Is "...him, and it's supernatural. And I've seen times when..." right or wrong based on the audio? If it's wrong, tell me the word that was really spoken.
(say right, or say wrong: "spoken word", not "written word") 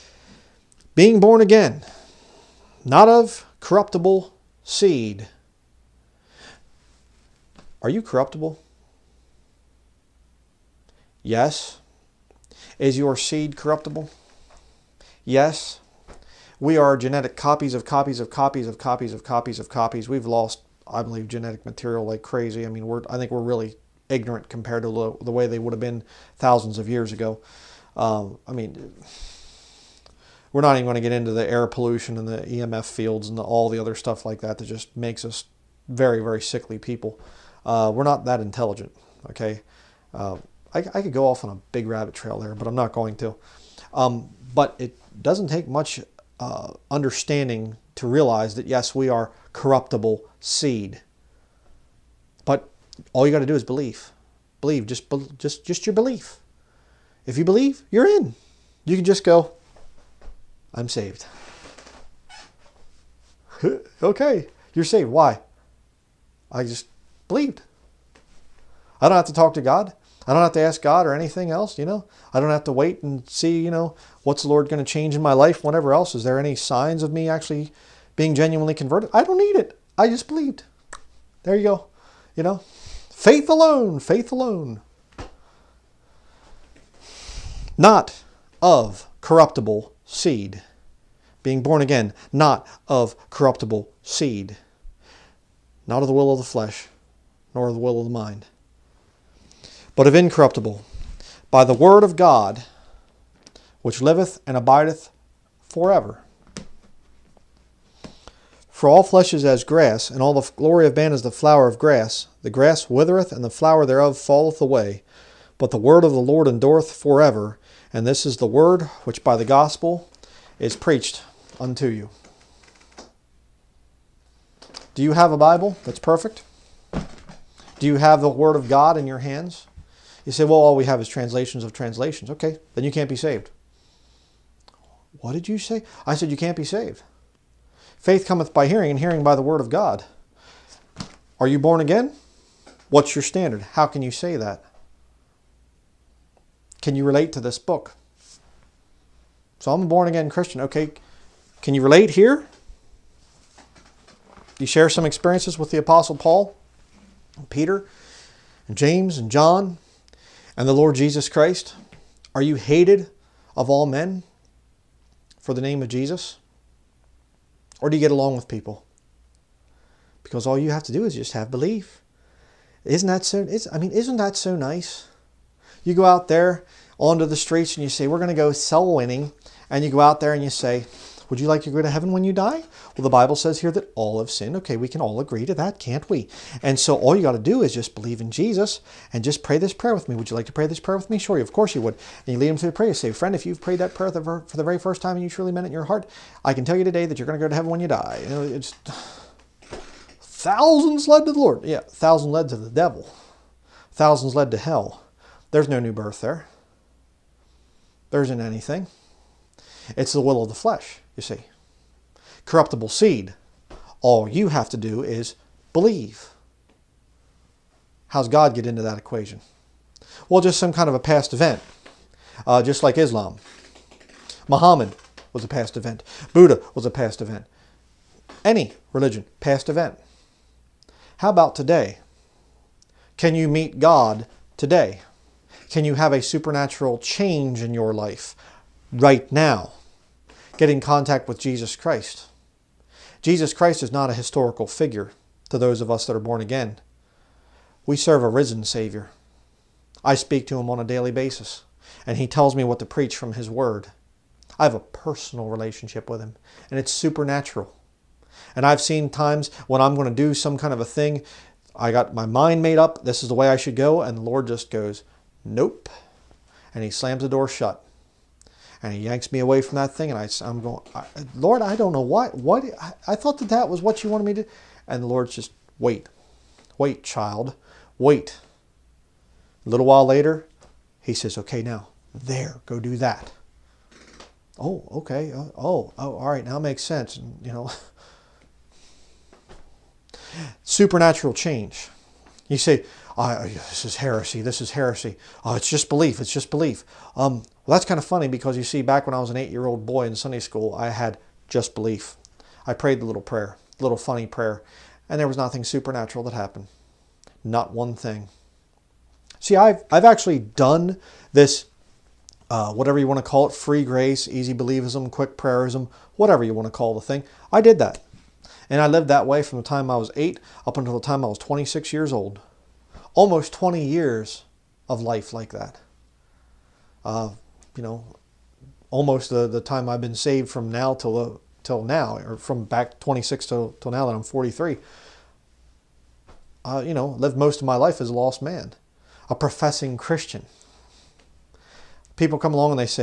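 right.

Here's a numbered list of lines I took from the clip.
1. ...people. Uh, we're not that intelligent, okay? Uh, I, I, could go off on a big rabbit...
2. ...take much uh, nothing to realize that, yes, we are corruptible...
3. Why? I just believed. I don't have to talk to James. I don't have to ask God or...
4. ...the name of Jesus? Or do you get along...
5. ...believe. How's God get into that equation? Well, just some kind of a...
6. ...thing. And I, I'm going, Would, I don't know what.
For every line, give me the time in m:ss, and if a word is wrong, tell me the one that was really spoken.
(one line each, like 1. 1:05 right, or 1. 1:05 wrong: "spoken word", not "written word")
1. 0:36 right
2. 0:45 wrong: "understanding", not "nothing"
3. 1:05 wrong: "God", not "James"
4. 2:45 right
5. 3:35 right
6. 4:29 wrong: "Lord", not "Would".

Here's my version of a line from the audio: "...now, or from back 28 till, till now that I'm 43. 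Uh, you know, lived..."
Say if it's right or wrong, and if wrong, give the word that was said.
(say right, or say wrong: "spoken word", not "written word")
wrong: "26", not "28".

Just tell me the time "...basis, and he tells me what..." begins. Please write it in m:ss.
4:11.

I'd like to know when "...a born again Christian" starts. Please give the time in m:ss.
2:29.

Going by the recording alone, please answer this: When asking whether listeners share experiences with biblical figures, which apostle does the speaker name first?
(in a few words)
Paul.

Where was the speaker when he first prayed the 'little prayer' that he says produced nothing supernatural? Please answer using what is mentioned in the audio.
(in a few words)
Sunday school.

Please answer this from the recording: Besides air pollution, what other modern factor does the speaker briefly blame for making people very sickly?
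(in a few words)
EMF fields.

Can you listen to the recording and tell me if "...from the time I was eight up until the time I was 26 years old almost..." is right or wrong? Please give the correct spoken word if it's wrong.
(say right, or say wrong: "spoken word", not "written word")
right.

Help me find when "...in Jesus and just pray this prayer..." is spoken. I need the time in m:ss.
3:08.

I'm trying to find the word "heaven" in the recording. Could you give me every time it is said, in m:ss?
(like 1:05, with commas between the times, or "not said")
3:01, 3:17.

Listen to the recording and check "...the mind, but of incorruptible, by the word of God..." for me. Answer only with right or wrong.
right.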